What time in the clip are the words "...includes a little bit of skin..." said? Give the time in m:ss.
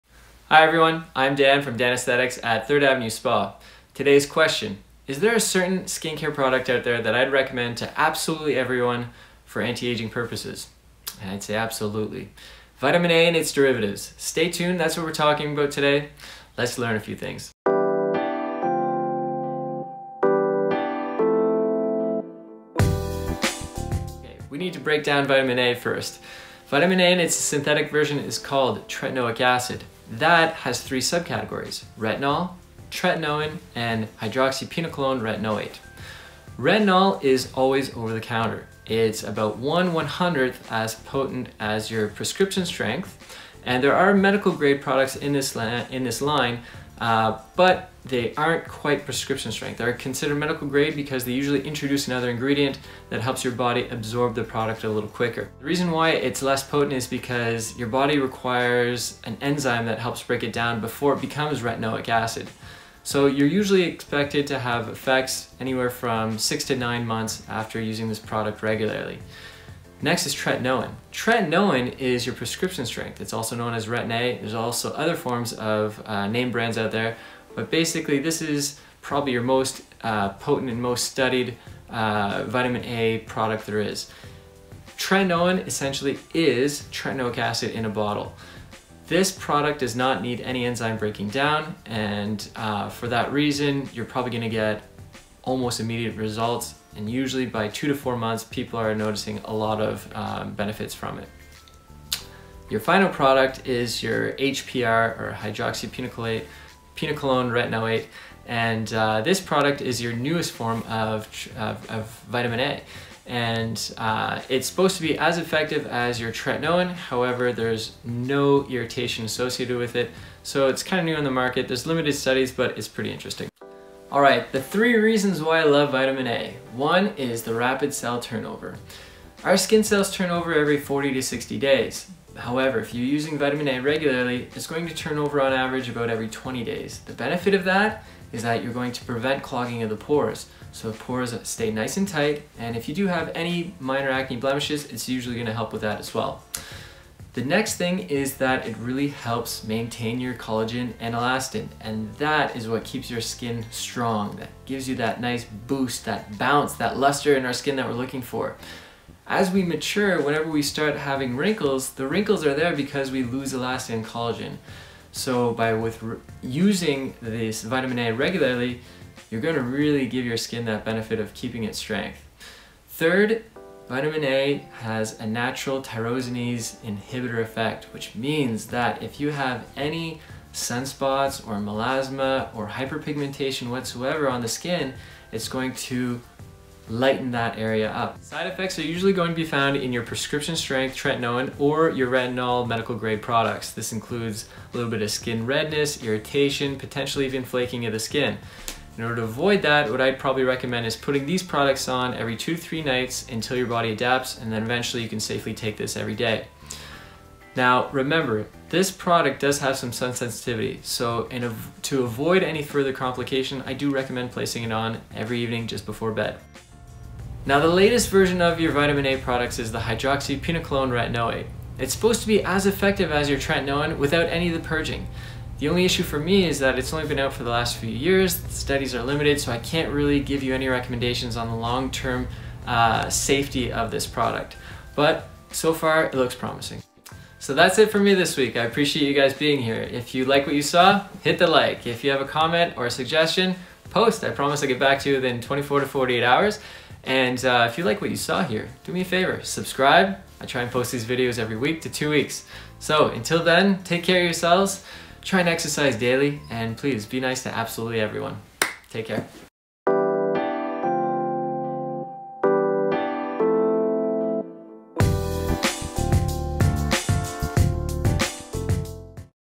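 3:13.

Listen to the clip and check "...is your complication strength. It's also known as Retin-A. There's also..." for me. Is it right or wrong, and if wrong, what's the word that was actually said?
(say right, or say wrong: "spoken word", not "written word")
wrong: "prescription", not "complication".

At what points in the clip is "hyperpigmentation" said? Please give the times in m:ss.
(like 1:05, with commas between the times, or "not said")
3:02.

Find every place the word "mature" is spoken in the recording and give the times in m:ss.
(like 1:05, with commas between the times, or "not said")
2:39.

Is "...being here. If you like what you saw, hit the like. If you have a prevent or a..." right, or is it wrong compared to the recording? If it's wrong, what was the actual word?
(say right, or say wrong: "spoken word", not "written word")
wrong: "comment", not "prevent".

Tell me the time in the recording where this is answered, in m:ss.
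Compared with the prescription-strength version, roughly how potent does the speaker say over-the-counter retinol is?
0:39.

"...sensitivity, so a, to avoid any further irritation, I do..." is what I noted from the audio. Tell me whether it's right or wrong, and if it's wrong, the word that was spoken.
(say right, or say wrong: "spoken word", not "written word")
wrong: "complication", not "irritation".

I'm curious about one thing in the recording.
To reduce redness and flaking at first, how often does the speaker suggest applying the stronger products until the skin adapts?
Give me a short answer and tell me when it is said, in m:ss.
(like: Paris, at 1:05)
every 2 to 3 nights, at 3:22.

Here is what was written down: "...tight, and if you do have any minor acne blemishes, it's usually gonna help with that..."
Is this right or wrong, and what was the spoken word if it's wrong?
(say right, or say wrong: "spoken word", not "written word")
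right.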